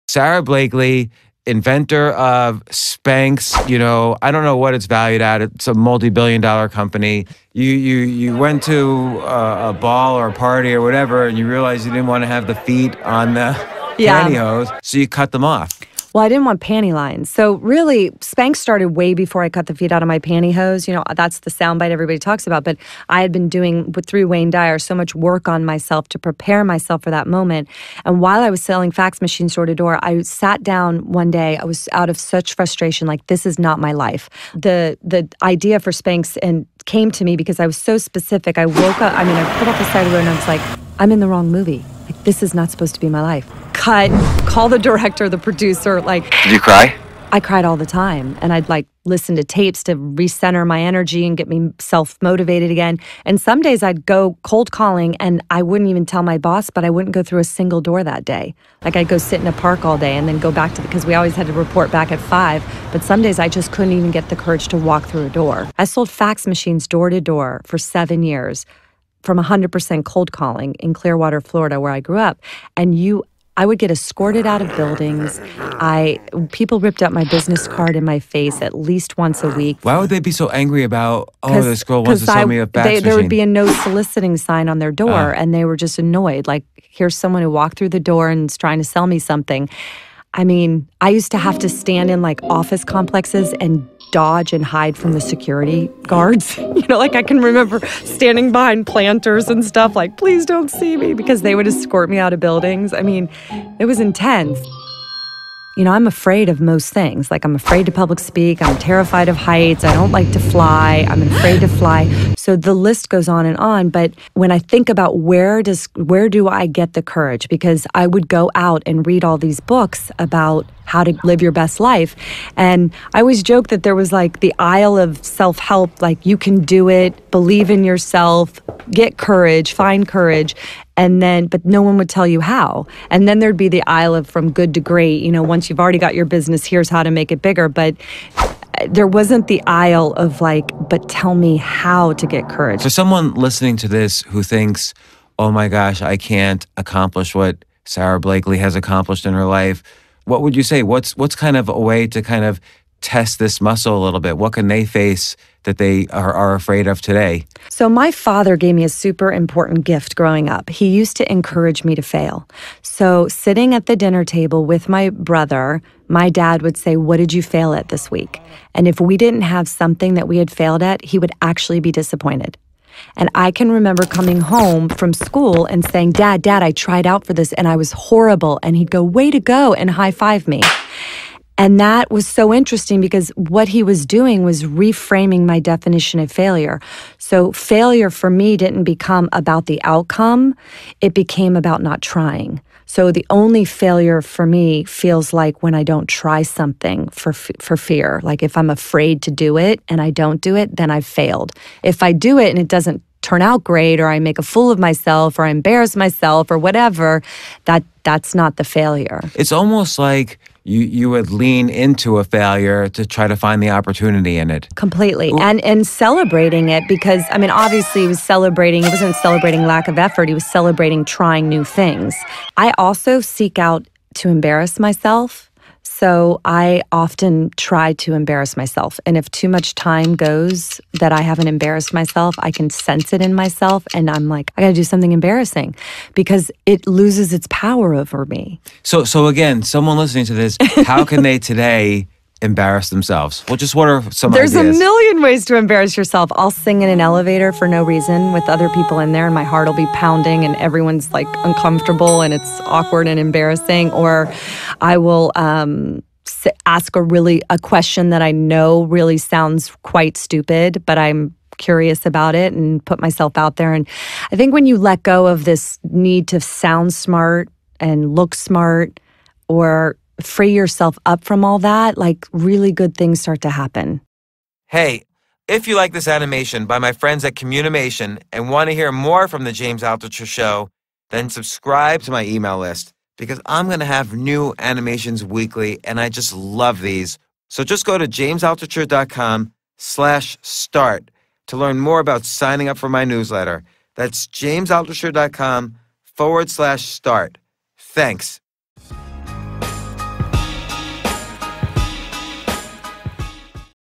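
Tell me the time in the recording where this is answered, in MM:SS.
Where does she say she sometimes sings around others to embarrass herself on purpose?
04:06.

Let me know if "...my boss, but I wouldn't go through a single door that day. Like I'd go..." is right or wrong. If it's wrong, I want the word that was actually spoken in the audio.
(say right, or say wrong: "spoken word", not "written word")
right.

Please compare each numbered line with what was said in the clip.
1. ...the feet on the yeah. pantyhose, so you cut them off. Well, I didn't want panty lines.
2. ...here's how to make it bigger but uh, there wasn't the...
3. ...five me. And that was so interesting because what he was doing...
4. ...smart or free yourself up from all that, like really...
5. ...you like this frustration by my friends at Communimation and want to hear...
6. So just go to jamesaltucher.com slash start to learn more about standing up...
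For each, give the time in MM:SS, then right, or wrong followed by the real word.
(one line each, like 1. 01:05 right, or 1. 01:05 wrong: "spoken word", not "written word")
1. 00:12 right
2. 02:16 right
3. 03:00 right
4. 04:28 right
5. 04:35 wrong: "animation", not "frustration"
6. 04:47 wrong: "signing", not "standing".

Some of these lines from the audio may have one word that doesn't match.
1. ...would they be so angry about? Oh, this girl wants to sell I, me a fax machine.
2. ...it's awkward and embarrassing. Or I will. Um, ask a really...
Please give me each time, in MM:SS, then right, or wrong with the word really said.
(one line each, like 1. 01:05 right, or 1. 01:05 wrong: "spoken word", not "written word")
1. 01:19 right
2. 04:12 right.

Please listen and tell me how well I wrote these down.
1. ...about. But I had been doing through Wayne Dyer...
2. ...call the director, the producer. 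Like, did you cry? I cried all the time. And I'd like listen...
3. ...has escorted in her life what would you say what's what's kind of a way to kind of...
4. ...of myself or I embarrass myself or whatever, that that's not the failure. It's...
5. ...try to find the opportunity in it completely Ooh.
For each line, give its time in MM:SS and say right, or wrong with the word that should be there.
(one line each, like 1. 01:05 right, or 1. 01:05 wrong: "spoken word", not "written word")
1. 00:22 right
2. 00:44 right
3. 02:28 wrong: "accomplished", not "escorted"
4. 03:24 right
5. 03:33 right.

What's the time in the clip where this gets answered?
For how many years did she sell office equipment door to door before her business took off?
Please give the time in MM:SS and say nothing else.
01:07.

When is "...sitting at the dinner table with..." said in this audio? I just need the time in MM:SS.
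02:43.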